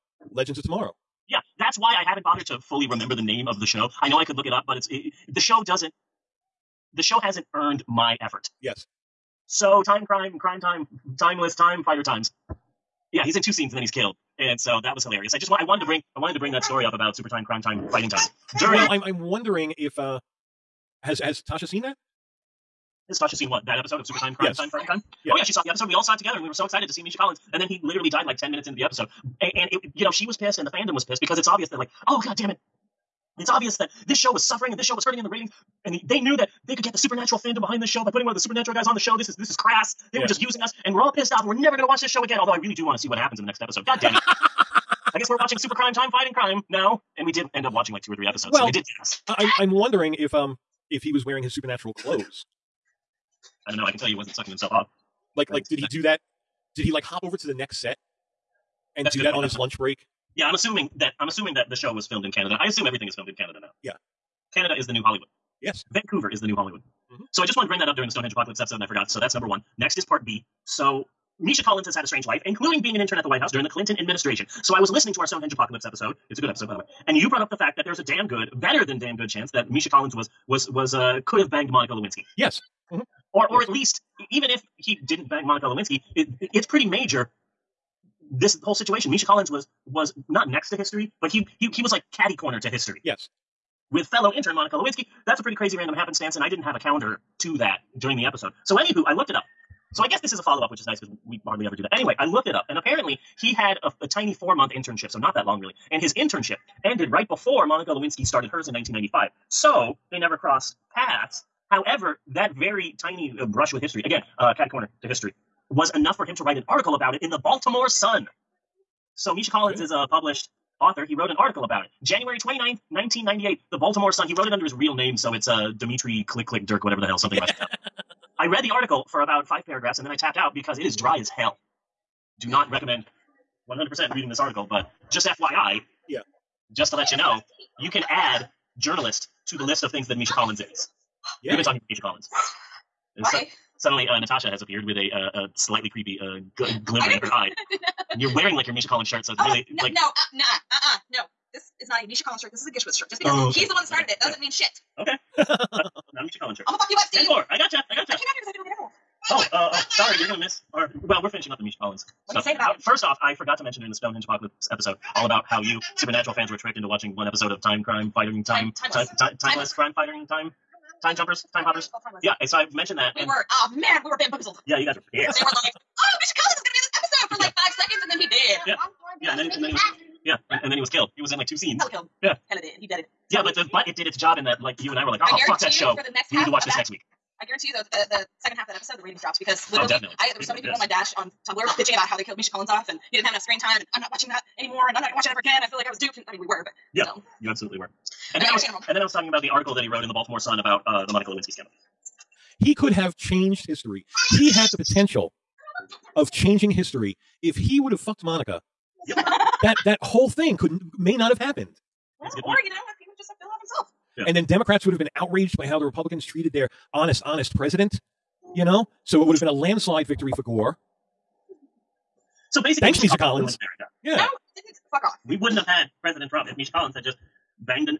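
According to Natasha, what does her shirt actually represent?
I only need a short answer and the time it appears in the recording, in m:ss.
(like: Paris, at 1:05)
GISHWHES, at 2:32.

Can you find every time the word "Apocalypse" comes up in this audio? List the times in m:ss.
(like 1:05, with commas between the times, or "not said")
1:08, 1:15, 2:44.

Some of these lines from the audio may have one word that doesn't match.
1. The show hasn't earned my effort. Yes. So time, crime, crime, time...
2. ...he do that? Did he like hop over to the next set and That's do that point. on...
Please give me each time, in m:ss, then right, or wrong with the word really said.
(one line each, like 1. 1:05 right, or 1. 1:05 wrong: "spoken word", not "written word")
1. 0:06 right
2. 0:55 right.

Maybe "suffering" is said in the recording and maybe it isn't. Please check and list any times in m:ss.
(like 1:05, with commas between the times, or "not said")
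0:34.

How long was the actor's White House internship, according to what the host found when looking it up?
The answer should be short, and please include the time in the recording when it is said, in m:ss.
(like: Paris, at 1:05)
4 months, at 1:44.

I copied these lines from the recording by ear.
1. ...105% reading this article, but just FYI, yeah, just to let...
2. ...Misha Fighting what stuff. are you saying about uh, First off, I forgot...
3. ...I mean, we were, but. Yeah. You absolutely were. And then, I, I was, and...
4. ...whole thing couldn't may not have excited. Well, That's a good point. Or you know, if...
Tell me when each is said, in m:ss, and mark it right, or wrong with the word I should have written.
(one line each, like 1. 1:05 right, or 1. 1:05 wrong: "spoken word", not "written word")
1. 2:13 wrong: "100", not "105"
2. 2:41 wrong: "Collins", not "Fighting"
3. 3:16 right
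4. 3:30 wrong: "happened", not "excited".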